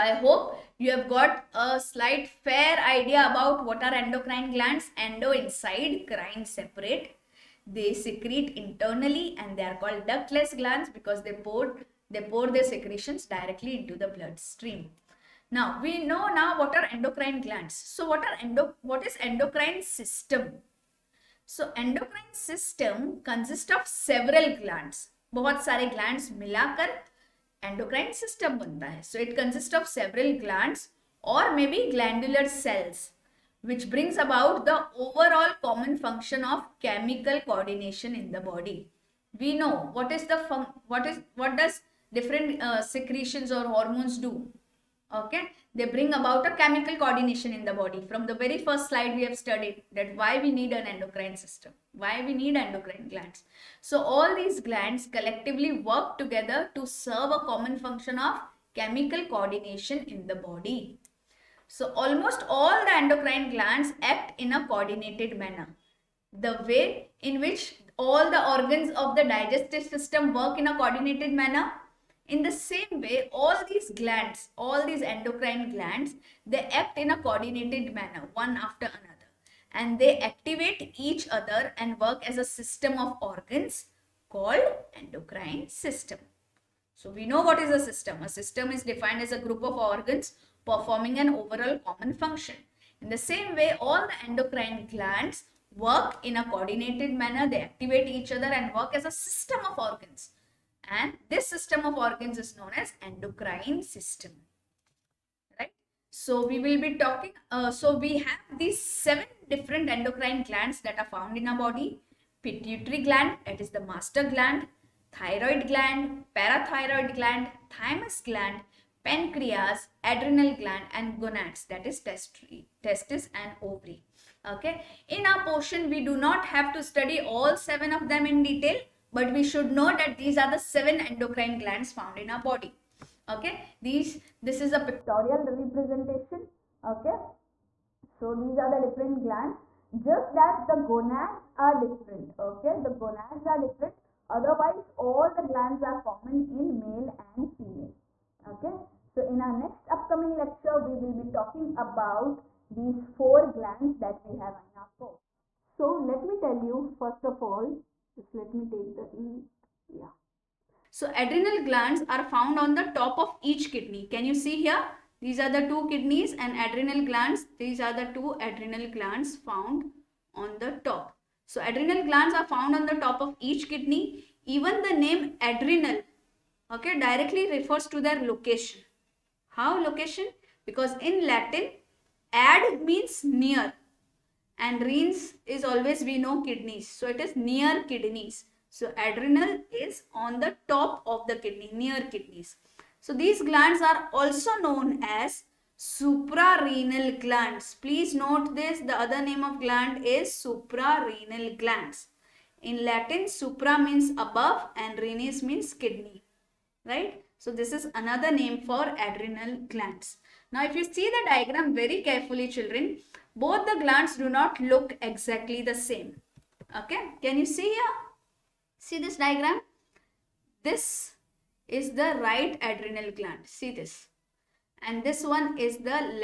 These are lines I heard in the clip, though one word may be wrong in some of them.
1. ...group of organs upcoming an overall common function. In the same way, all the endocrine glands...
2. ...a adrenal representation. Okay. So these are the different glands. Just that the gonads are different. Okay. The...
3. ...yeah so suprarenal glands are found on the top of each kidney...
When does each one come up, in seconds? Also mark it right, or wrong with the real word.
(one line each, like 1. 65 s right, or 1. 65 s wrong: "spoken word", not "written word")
1. 89 s wrong: "performing", not "upcoming"
2. 134 s wrong: "pictorial", not "adrenal"
3. 159 s wrong: "adrenal", not "suprarenal".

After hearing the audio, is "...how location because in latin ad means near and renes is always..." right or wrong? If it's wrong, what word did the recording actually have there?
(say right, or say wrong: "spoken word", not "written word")
right.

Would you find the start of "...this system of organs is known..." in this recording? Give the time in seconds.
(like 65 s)
101 s.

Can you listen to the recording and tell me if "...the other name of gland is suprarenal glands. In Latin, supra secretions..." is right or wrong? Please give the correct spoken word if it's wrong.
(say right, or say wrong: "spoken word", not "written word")
wrong: "means", not "secretions".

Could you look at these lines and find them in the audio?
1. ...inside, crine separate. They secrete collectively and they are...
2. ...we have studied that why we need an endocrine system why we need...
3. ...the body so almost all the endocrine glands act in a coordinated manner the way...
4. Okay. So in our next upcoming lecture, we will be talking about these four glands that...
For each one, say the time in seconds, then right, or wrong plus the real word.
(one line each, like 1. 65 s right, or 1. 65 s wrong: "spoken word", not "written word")
1. 5 s wrong: "internally", not "collectively"
2. 49 s right
3. 60 s right
4. 148 s right.